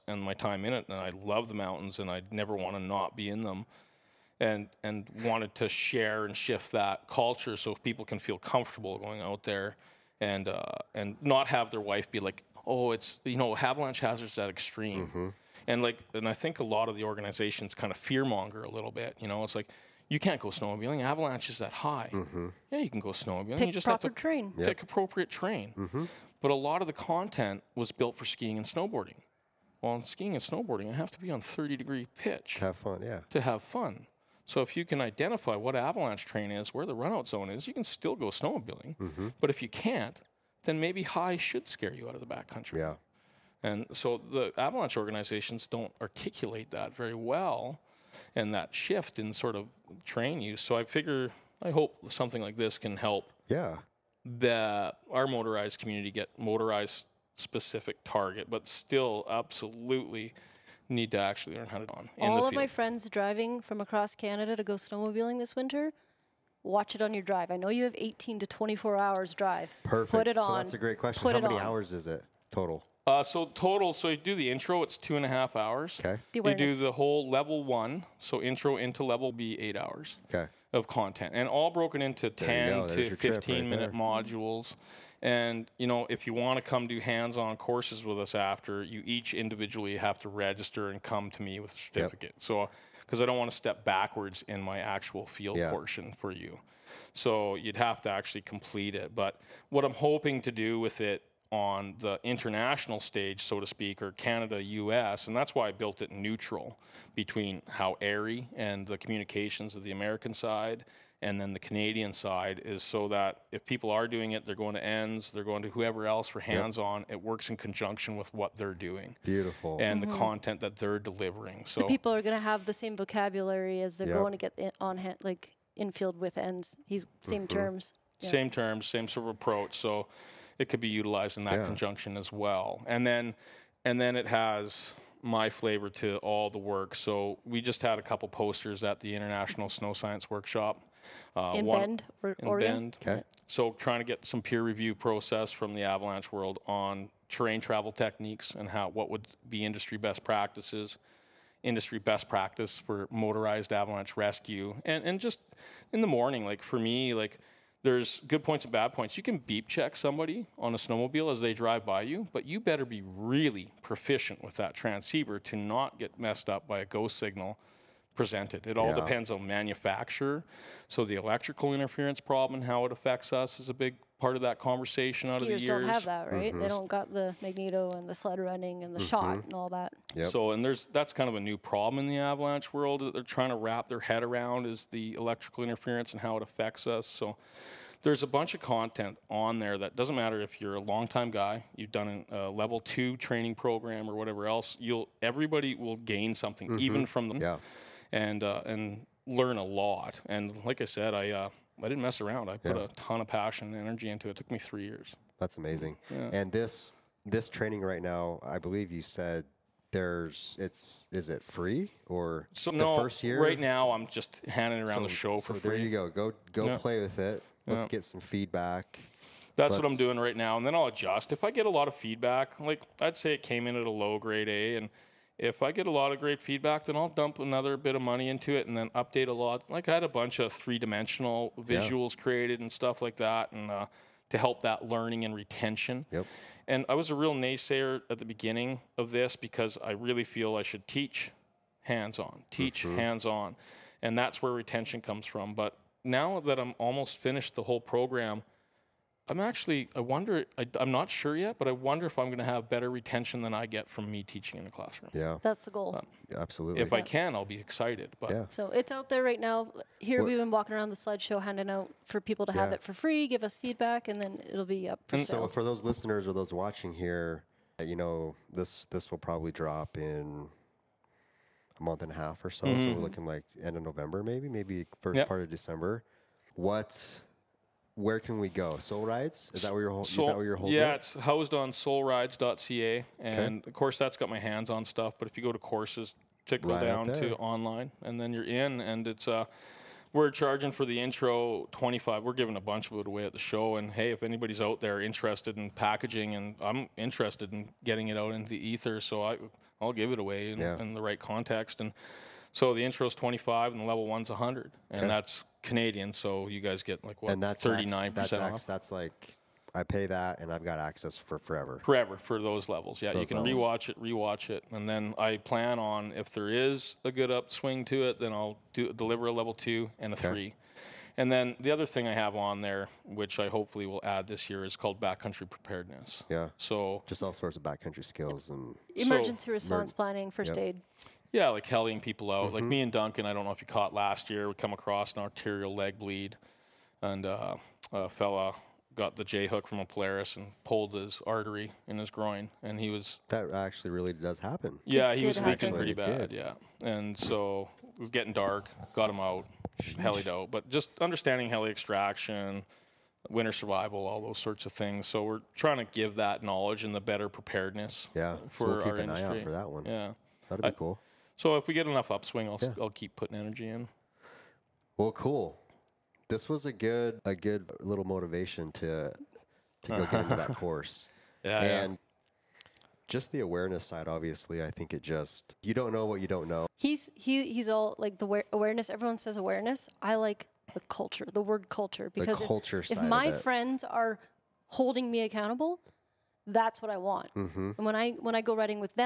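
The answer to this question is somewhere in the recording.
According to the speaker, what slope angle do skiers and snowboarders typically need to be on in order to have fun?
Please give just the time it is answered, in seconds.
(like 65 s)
31 s.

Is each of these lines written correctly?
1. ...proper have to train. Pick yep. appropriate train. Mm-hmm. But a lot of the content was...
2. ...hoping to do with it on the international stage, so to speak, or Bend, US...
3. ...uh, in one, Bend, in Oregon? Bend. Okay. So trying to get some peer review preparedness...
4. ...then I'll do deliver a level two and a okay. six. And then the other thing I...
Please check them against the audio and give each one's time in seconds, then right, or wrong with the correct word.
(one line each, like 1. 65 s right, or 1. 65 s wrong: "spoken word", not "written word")
1. 23 s right
2. 99 s wrong: "Canada", not "Bend"
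3. 141 s wrong: "process", not "preparedness"
4. 318 s wrong: "three", not "six".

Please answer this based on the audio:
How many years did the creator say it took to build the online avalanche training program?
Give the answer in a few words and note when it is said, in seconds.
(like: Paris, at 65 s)
3 years, at 204 s.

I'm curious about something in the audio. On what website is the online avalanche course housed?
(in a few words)
soulrides.ca.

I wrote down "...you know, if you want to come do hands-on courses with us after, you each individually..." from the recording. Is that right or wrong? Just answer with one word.
right.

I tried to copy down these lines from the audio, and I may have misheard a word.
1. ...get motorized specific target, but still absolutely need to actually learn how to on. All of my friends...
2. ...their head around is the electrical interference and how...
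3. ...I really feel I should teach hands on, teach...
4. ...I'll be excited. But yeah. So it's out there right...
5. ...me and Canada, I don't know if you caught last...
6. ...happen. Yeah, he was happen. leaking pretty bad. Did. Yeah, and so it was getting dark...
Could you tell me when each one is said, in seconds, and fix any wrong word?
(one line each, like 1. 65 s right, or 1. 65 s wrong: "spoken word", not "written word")
1. 56 s right
2. 183 s right
3. 239 s right
4. 257 s right
5. 332 s wrong: "Duncan", not "Canada"
6. 344 s right.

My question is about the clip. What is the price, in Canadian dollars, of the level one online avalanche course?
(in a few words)
100.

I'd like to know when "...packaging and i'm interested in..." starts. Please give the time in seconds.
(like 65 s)
295 s.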